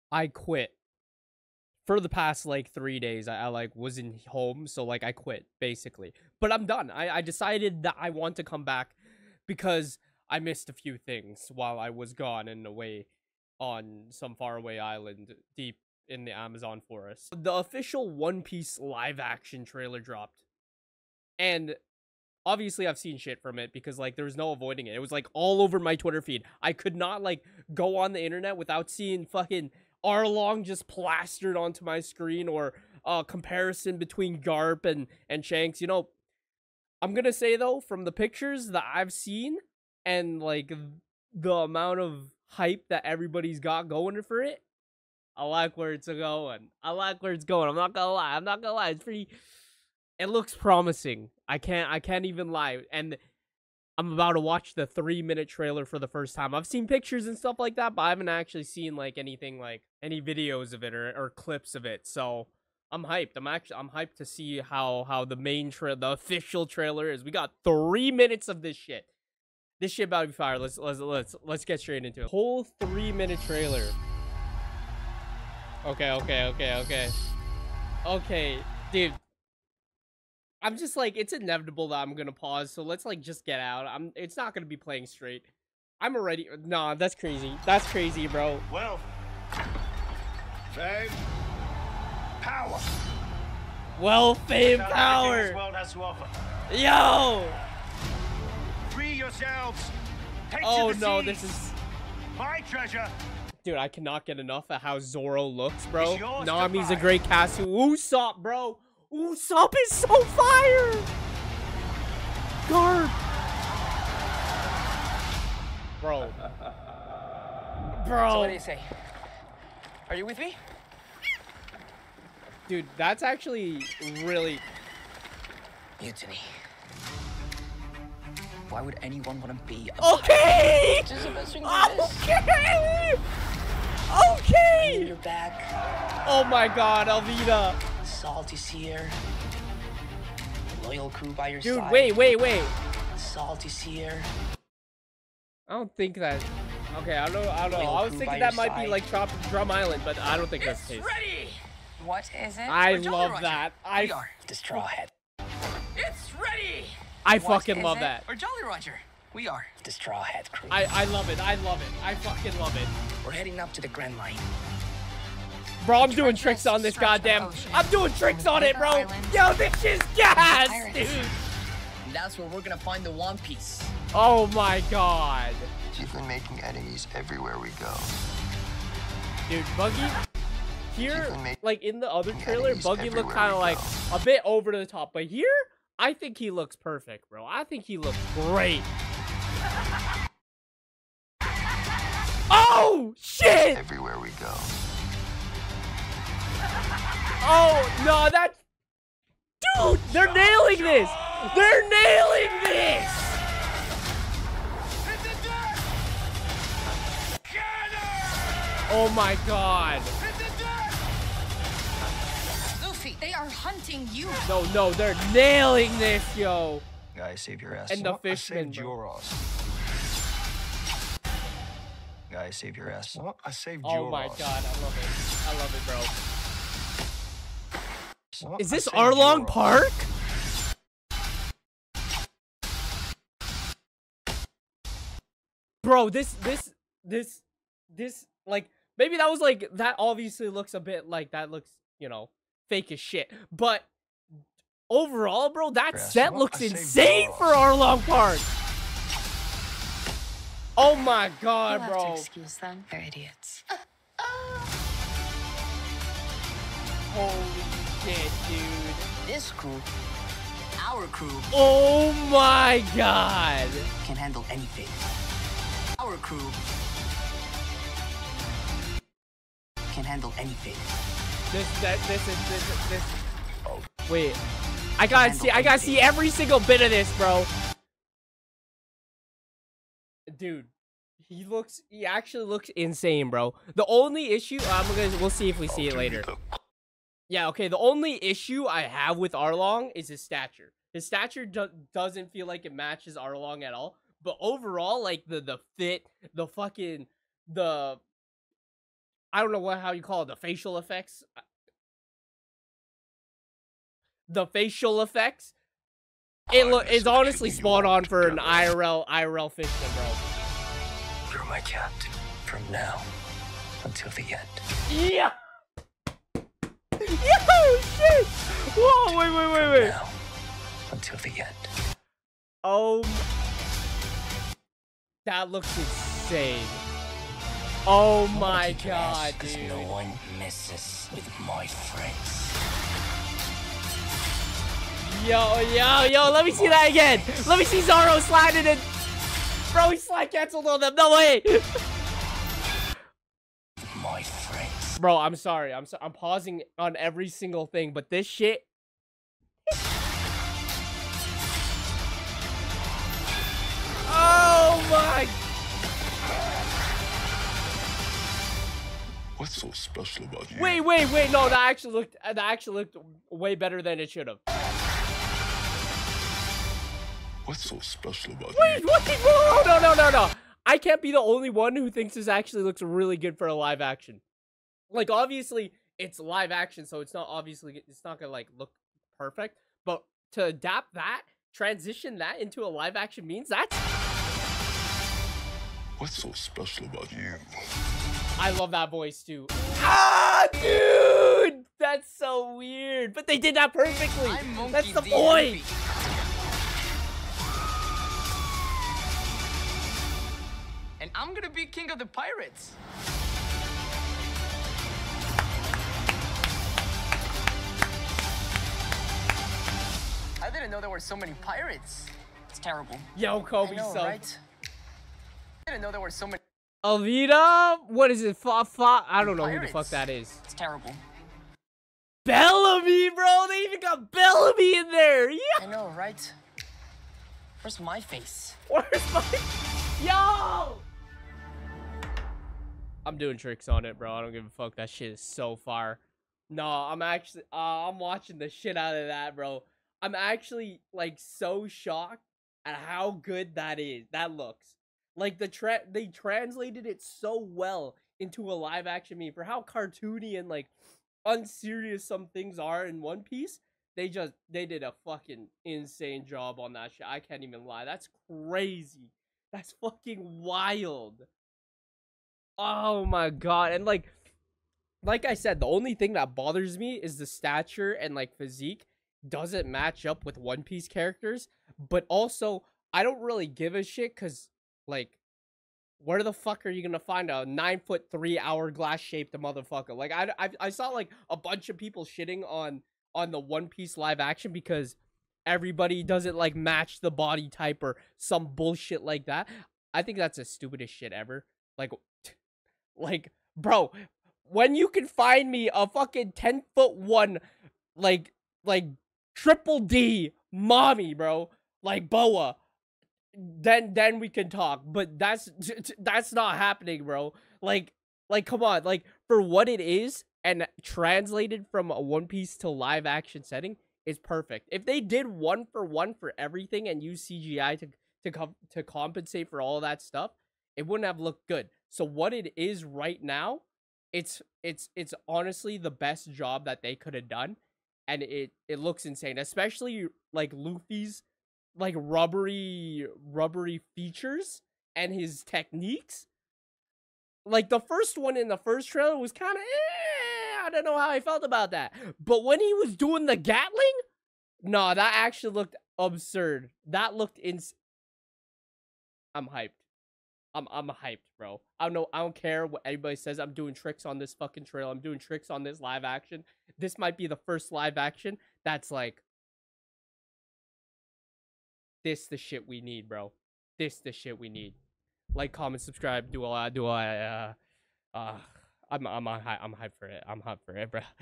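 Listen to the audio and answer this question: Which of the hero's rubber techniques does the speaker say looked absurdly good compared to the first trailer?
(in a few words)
Gatling.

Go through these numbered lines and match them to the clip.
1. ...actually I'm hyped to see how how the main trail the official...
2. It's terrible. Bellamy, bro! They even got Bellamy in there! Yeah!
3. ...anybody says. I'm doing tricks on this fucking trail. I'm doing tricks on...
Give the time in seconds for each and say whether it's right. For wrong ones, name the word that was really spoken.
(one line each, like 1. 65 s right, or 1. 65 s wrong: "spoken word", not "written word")
1. 63 s right
2. 420 s right
3. 552 s right.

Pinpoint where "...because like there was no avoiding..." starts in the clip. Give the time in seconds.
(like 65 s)
23 s.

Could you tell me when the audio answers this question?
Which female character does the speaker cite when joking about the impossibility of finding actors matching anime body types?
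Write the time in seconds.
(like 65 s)
502 s.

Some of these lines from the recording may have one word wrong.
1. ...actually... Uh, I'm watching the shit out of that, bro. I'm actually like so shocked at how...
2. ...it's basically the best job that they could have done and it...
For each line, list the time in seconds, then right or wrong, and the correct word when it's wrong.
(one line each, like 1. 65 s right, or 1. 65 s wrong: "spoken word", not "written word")
1. 437 s right
2. 524 s wrong: "honestly", not "basically".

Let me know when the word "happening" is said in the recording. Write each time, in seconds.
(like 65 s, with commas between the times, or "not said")
506 s.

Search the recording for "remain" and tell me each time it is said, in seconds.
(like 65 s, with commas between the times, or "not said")
not said.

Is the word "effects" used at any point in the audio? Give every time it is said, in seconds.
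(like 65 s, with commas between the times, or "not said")
300 s, 305 s.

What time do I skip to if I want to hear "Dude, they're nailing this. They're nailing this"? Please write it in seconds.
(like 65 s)
199 s.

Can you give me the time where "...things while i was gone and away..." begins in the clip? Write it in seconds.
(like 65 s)
10 s.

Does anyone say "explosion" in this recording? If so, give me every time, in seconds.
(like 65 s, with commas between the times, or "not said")
not said.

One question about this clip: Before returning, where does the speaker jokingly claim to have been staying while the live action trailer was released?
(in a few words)
Amazon forest.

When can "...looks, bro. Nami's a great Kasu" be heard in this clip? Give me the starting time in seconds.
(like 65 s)
105 s.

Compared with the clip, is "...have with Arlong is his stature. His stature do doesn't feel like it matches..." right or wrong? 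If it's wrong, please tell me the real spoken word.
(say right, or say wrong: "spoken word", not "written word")
right.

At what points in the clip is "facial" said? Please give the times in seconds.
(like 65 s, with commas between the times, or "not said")
300 s, 304 s.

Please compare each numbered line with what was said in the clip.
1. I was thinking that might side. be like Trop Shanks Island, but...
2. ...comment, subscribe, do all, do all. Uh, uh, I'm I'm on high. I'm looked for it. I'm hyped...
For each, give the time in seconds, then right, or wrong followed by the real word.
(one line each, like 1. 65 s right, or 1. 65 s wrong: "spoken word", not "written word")
1. 147 s wrong: "Drum", not "Shanks"
2. 565 s wrong: "hyped", not "looked".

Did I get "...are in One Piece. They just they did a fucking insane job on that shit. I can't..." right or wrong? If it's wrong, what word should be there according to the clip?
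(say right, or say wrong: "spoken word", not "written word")
right.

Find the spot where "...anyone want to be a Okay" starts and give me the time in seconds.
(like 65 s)
129 s.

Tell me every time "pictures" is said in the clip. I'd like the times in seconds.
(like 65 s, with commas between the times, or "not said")
38 s, 56 s.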